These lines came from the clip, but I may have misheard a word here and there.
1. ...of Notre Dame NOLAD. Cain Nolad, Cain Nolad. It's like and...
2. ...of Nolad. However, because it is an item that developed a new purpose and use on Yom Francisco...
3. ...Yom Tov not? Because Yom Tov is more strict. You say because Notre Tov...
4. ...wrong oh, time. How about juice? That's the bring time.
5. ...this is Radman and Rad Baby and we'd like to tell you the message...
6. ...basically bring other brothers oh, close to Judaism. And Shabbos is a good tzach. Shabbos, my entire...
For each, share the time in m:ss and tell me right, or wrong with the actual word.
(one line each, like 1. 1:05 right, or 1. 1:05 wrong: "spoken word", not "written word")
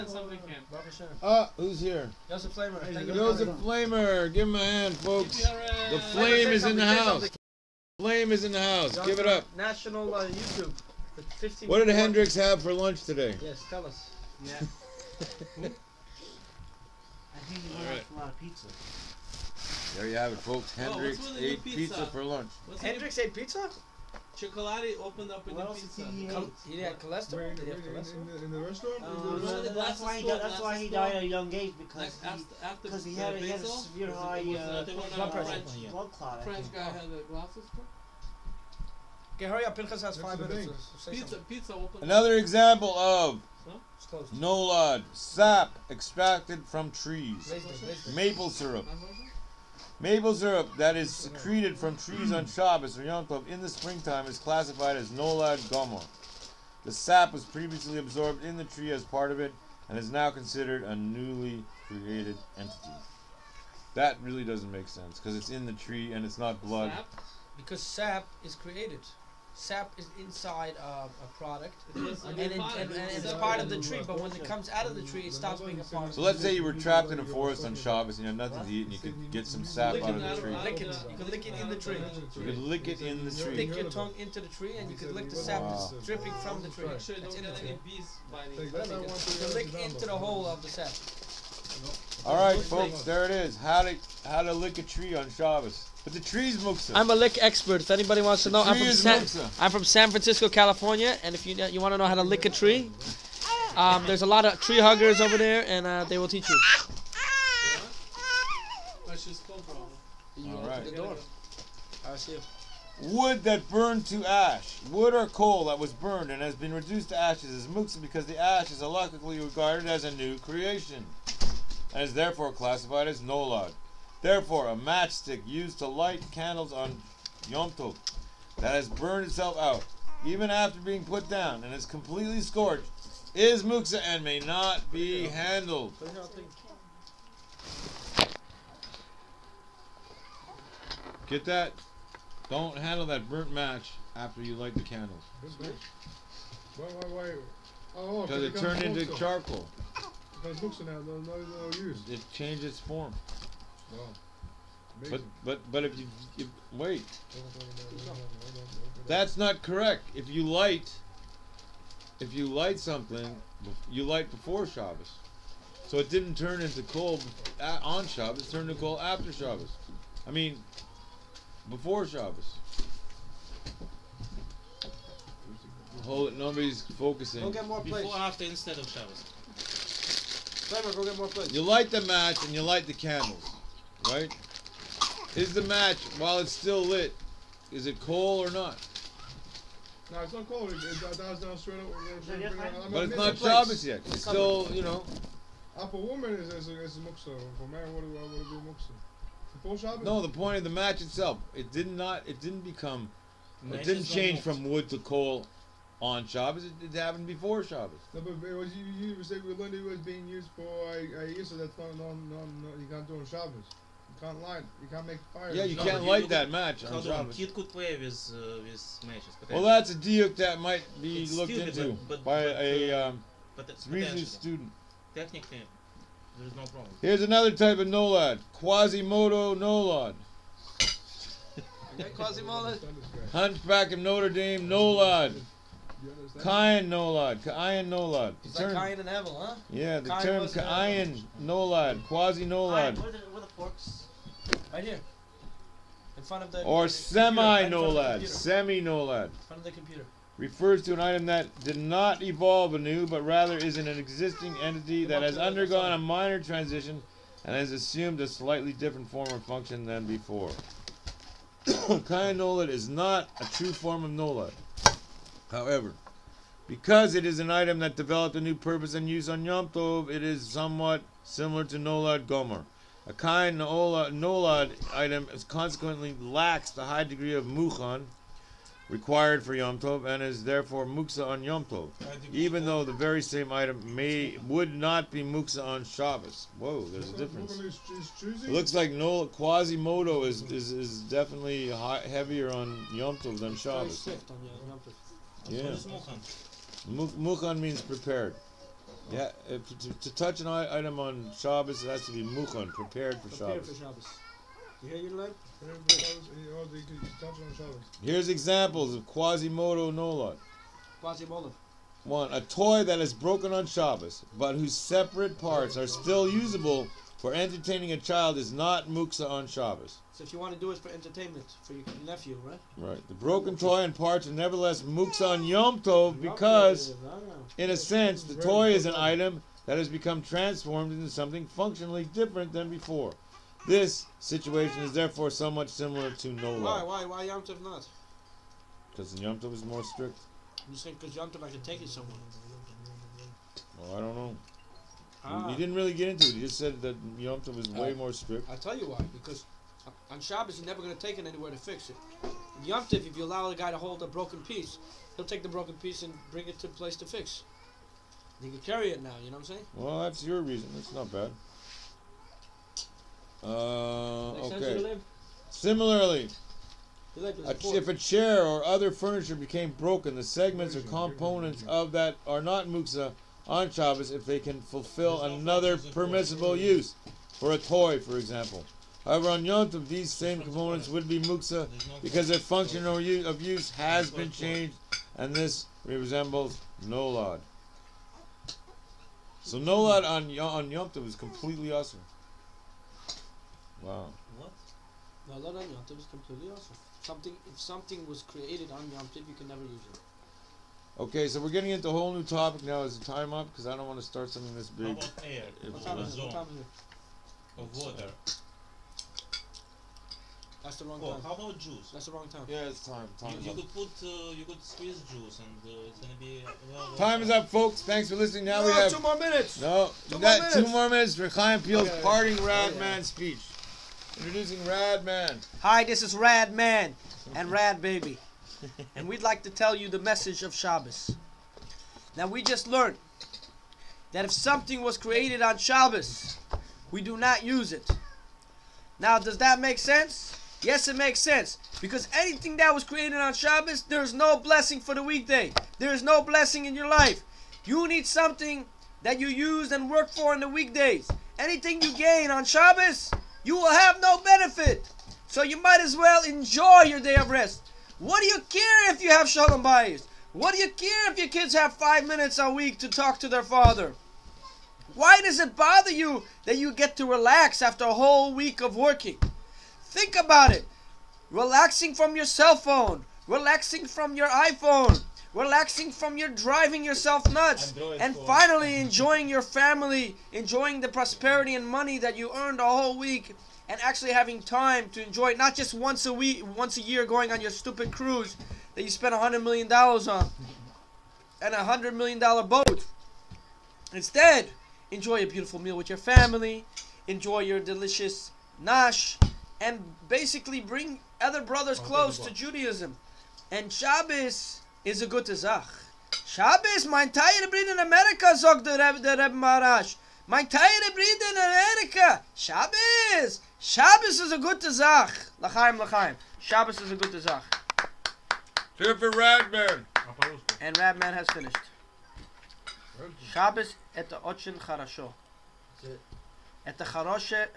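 1. 3:53 right
2. 4:24 wrong: "Tov", not "Francisco"
3. 5:37 wrong: "Yom", not "Notre"
4. 6:50 wrong: "wrong", not "bring"
5. 7:05 right
6. 8:20 right.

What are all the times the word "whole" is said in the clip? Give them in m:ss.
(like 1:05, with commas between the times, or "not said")
6:41, 7:47, 8:02.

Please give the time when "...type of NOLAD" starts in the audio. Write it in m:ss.
3:47.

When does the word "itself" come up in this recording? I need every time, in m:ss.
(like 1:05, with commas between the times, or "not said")
2:09, 3:20.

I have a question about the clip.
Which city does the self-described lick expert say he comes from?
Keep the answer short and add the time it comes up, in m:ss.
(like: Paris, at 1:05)
San Francisco, at 1:39.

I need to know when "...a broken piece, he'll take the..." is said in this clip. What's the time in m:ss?
5:54.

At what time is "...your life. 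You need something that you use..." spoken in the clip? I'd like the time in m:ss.
7:26.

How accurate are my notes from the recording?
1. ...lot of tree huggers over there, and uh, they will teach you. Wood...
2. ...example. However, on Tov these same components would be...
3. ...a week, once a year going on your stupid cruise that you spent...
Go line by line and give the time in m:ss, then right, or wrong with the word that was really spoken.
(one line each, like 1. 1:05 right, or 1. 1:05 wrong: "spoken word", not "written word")
1. 1:44 right
2. 6:18 wrong: "Yom", not "Tov"
3. 8:06 right.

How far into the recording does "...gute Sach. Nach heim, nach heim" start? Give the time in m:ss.
8:34.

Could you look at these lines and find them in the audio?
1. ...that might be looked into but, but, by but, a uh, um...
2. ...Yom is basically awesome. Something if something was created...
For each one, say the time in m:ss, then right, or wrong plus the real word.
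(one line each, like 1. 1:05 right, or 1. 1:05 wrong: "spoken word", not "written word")
1. 3:40 right
2. 6:35 wrong: "completely", not "basically".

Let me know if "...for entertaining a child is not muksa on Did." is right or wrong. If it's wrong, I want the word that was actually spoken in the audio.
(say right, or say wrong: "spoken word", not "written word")
wrong: "Shabbos", not "Did".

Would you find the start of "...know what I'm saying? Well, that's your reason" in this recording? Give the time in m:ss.
5:59.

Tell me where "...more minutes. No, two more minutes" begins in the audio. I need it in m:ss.
6:59.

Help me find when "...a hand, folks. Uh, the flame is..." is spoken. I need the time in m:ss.
0:04.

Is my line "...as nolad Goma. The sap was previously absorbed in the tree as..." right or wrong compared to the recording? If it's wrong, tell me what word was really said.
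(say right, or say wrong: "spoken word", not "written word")
right.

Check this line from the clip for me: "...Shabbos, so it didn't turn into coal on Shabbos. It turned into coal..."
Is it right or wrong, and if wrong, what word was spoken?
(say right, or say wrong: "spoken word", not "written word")
right.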